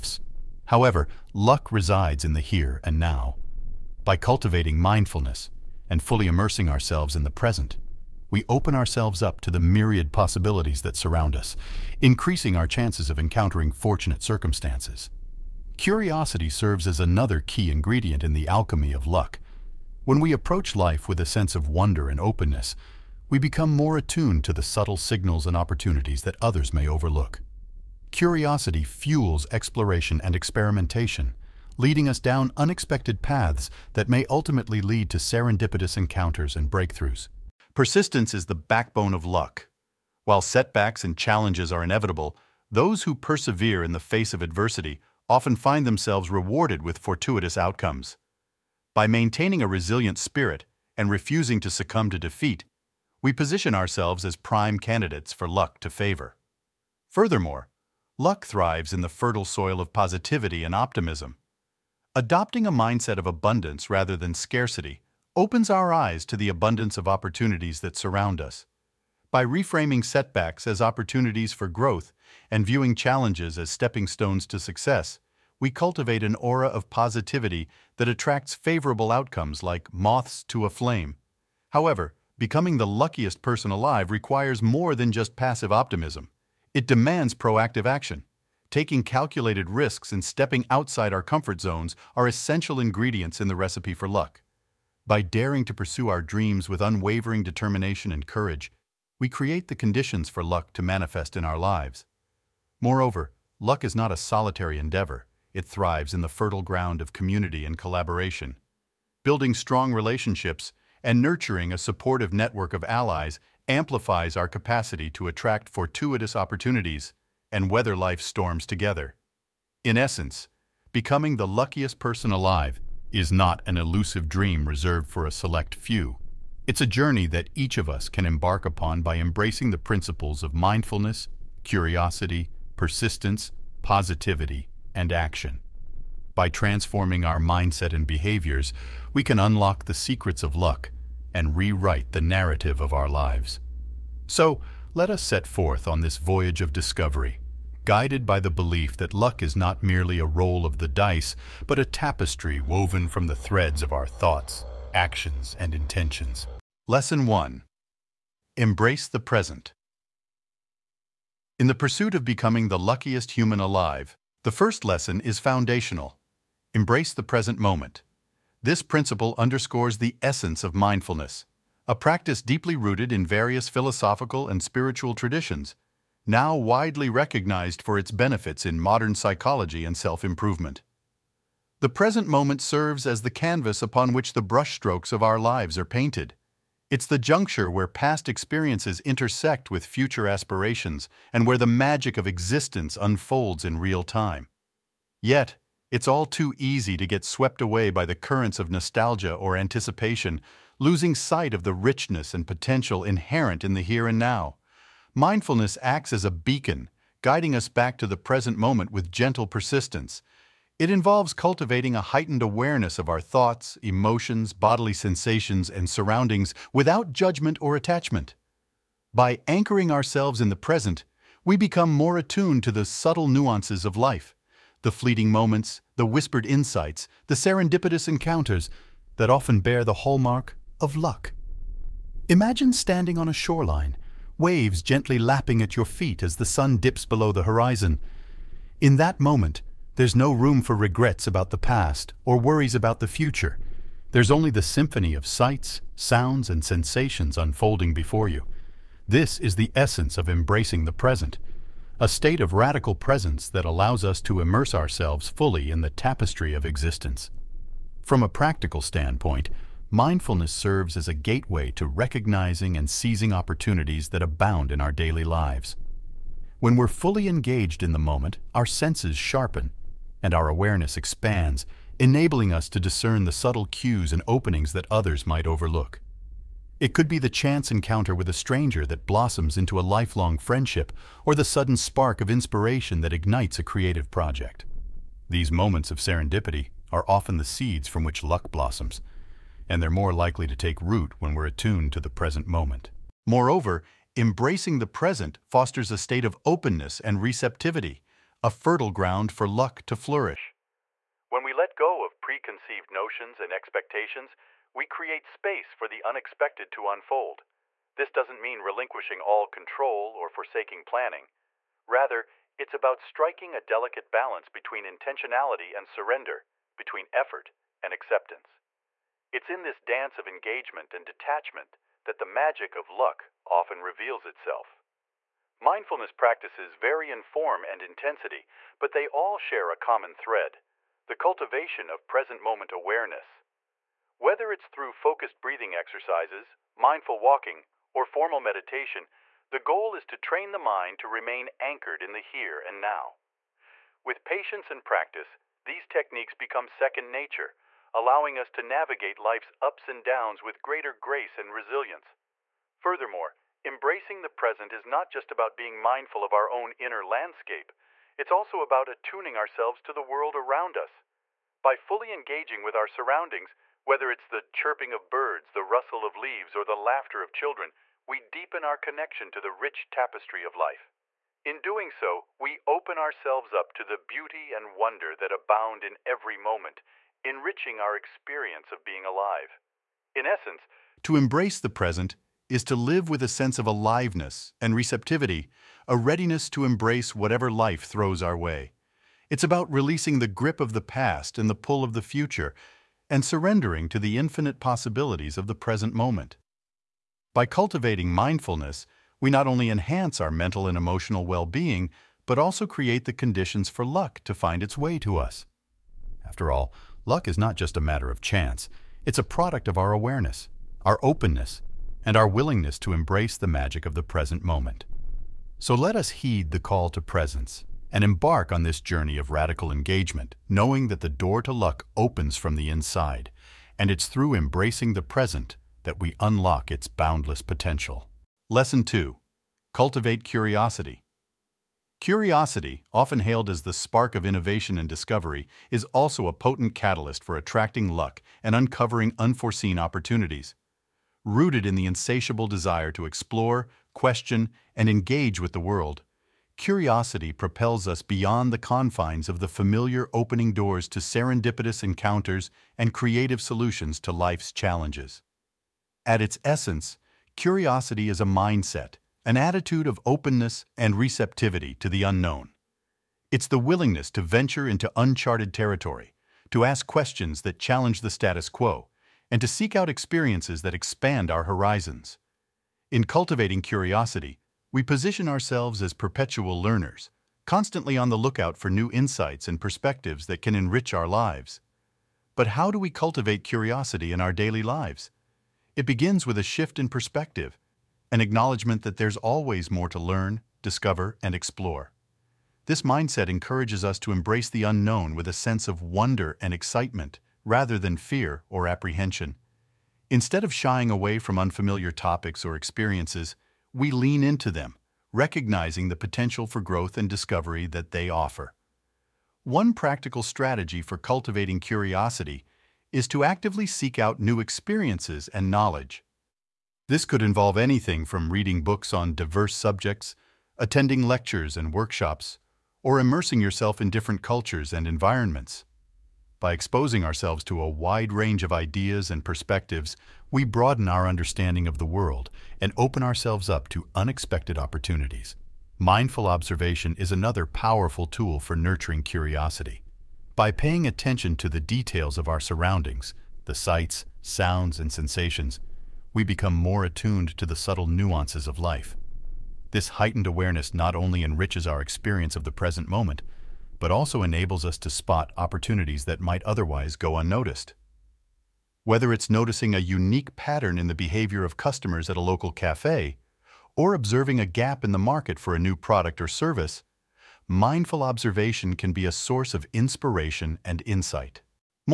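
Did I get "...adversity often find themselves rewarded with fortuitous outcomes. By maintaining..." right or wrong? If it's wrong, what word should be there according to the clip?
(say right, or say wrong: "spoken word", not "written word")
right.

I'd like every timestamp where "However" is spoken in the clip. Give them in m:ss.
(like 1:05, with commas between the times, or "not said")
0:00, 1:21.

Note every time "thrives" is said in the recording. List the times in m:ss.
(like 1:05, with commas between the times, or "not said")
0:58, 1:45.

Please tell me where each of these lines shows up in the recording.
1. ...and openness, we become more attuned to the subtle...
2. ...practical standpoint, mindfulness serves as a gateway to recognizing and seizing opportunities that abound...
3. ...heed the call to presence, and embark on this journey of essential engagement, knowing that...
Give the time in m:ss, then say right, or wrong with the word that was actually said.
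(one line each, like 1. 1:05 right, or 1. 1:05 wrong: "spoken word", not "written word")
1. 0:22 right
2. 4:18 right
3. 6:56 wrong: "radical", not "essential".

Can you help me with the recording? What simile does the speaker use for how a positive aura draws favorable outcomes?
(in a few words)
Moths to a flame.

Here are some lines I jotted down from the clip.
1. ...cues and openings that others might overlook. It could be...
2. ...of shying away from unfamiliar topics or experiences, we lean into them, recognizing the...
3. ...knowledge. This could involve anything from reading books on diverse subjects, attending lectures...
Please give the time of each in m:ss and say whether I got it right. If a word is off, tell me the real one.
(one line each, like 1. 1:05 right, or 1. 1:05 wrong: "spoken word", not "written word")
1. 4:33 right
2. 8:20 right
3. 8:35 right.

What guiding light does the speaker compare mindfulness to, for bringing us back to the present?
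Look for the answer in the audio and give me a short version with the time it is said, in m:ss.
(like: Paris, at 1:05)
A beacon, at 3:26.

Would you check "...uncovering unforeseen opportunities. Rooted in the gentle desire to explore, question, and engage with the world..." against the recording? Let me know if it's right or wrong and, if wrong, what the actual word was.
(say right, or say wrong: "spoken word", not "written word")
wrong: "insatiable", not "gentle".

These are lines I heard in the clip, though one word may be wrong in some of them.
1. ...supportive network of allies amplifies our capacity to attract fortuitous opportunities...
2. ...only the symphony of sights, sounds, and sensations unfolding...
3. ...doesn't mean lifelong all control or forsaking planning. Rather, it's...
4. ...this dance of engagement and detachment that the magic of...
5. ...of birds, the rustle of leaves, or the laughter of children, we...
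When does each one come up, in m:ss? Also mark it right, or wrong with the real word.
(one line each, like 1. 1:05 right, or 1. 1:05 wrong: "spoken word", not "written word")
1. 1:51 right
2. 4:04 right
3. 5:08 wrong: "relinquishing", not "lifelong"
4. 5:19 right
5. 6:04 right.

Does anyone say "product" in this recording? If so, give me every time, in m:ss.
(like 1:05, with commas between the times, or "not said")
6:49, 9:25.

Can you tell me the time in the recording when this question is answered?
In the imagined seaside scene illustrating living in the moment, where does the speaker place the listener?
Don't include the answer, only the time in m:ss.
3:53.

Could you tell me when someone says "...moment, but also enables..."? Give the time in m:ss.
9:12.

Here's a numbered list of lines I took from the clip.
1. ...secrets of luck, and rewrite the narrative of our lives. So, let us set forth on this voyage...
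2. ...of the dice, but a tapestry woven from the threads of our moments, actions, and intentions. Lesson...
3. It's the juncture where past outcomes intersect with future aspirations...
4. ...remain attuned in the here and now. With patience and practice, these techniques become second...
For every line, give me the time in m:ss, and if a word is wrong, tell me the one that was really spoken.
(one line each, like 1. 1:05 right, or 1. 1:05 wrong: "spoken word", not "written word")
1. 2:19 right
2. 2:30 wrong: "thoughts", not "moments"
3. 3:06 wrong: "experiences", not "outcomes"
4. 5:41 wrong: "anchored", not "attuned".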